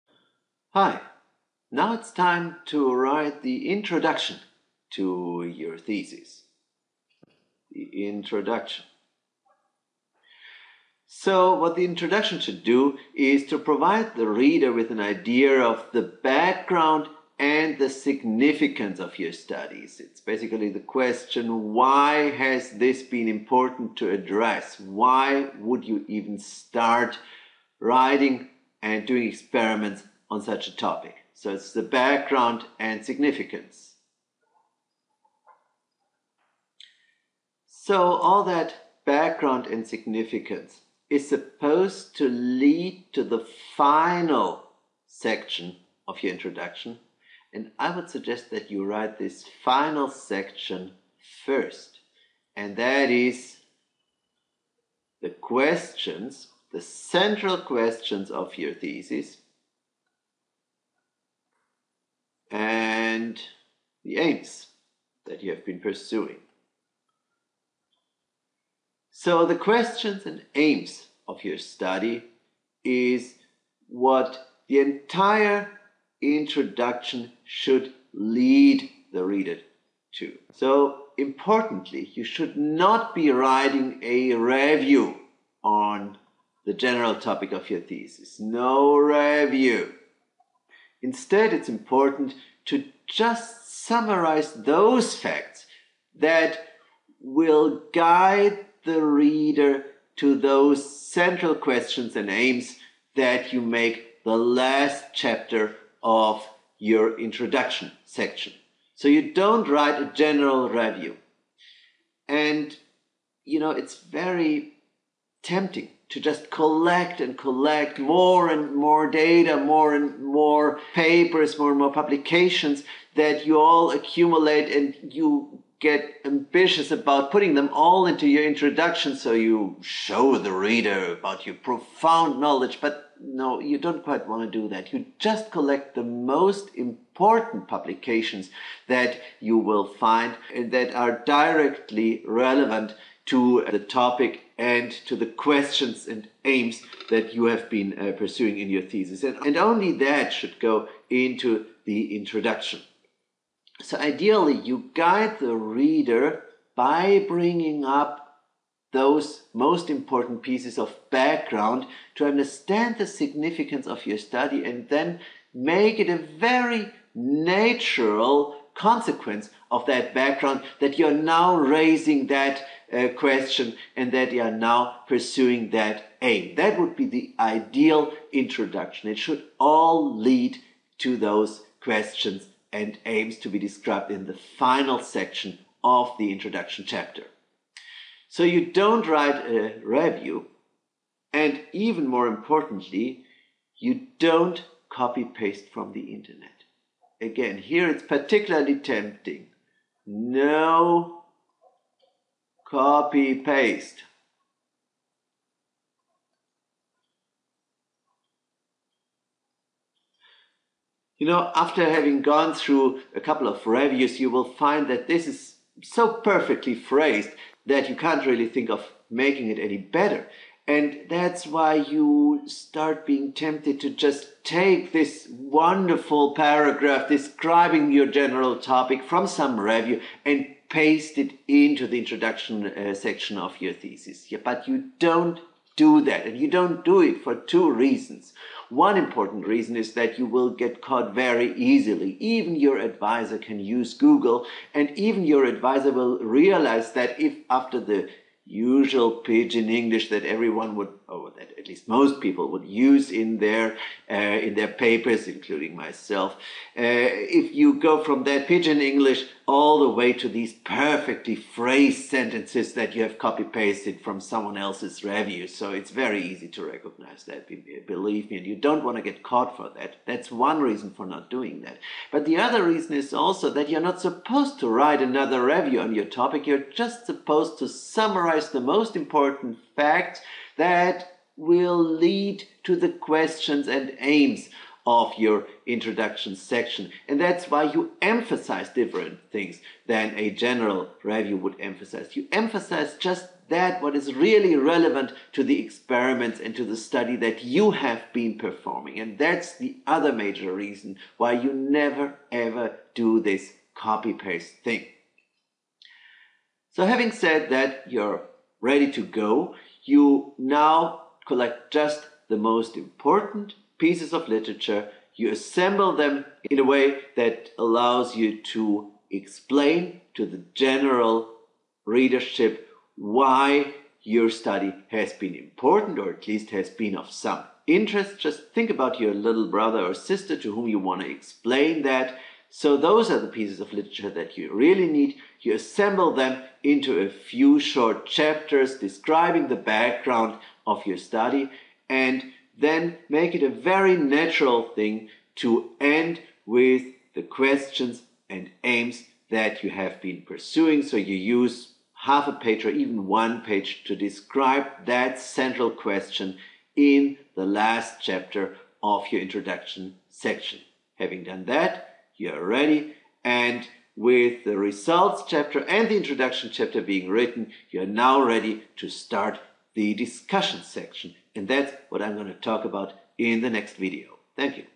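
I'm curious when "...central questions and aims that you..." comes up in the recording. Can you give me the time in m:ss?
1:41.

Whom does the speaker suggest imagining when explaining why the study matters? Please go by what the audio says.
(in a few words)
little brother or sister.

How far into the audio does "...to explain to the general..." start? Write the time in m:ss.
5:18.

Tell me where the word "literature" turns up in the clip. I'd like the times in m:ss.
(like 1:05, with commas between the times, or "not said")
5:14, 5:33.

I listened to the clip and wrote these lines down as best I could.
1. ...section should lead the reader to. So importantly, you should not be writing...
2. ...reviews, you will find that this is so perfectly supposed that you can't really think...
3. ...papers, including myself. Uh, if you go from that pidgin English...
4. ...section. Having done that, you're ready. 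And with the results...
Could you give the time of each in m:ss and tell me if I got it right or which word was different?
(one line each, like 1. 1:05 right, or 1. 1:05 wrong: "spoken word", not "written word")
1. 1:16 wrong: "introduction", not "section"
2. 3:33 wrong: "phrased", not "supposed"
3. 4:14 right
4. 6:00 right.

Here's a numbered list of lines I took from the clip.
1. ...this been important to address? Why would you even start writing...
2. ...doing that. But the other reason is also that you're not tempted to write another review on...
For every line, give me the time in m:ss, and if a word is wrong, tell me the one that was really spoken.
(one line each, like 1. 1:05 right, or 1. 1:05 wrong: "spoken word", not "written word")
1. 0:22 right
2. 4:31 wrong: "supposed", not "tempted".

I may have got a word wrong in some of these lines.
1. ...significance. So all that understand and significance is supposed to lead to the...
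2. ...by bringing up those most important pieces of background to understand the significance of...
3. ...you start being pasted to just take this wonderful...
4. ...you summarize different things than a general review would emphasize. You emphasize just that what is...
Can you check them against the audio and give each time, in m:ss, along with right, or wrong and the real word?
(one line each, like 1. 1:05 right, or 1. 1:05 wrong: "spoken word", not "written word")
1. 0:33 wrong: "background", not "understand"
2. 2:36 right
3. 3:41 wrong: "tempted", not "pasted"
4. 4:47 wrong: "emphasize", not "summarize".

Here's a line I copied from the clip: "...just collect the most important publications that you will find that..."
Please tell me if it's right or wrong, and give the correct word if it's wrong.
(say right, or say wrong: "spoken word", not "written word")
right.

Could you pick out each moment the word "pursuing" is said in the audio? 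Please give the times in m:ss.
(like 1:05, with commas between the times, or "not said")
1:05, 2:28, 2:55, 5:50.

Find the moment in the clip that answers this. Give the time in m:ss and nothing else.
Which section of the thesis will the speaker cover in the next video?
6:09.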